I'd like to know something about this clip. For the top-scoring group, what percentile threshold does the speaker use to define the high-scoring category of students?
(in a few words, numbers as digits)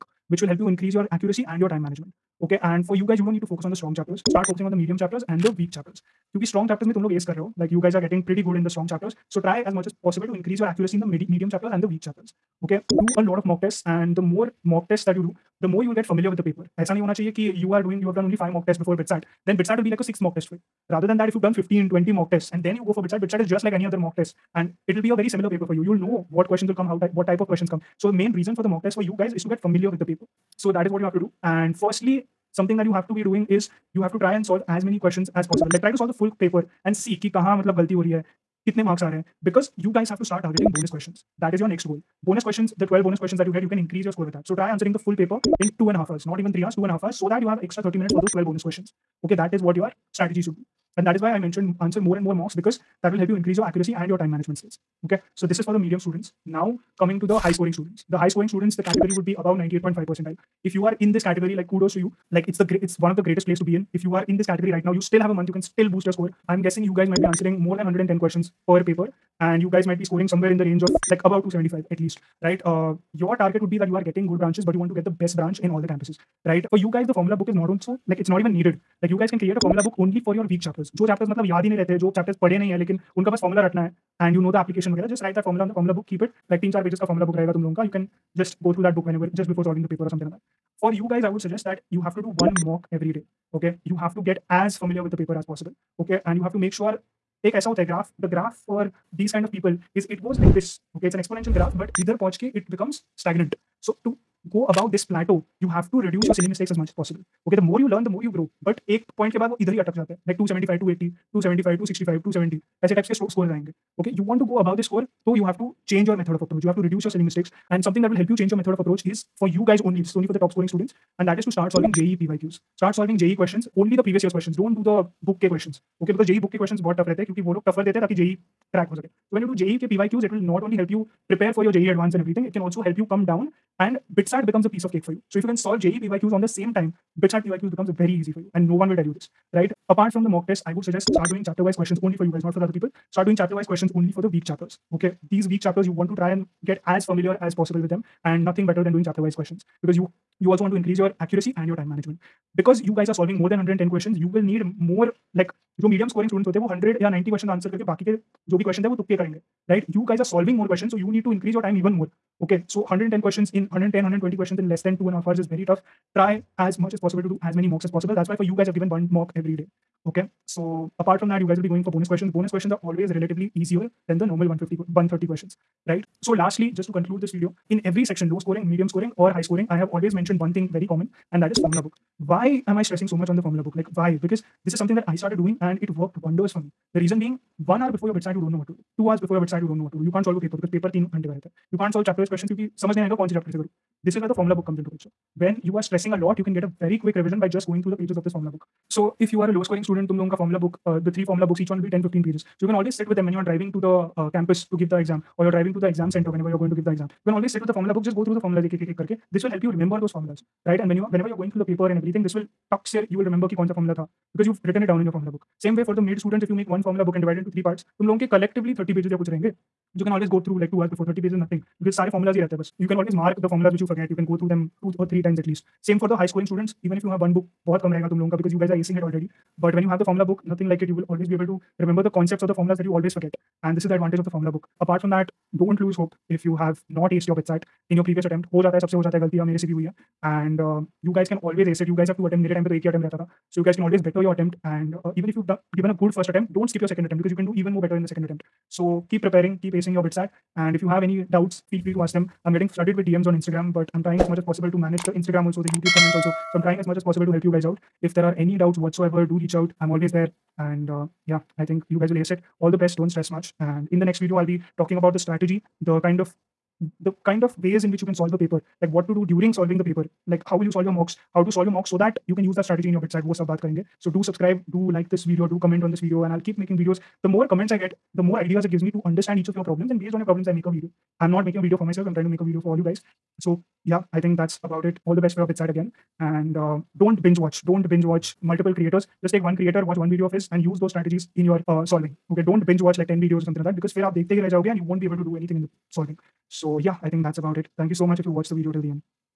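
98.5 percentile.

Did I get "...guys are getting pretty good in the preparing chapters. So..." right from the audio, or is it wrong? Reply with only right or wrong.
wrong.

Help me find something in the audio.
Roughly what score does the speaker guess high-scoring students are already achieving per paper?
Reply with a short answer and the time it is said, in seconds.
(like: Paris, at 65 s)
275, at 71 s.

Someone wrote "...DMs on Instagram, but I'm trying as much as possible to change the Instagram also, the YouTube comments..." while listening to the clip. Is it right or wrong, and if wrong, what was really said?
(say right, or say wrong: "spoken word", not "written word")
wrong: "manage", not "change".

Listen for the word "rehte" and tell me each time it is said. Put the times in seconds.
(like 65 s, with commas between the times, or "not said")
81 s.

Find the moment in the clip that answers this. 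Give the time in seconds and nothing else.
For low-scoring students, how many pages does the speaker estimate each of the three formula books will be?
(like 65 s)
201 s.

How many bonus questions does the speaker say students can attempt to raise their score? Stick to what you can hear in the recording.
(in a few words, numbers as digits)
12.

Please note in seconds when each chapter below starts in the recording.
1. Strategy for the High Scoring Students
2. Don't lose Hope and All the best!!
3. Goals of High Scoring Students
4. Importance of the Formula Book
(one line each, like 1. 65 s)
1. 80 s
2. 233 s
3. 55 s
4. 177 s.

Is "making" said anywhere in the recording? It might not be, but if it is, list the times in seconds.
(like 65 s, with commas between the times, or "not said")
276 s, 281 s.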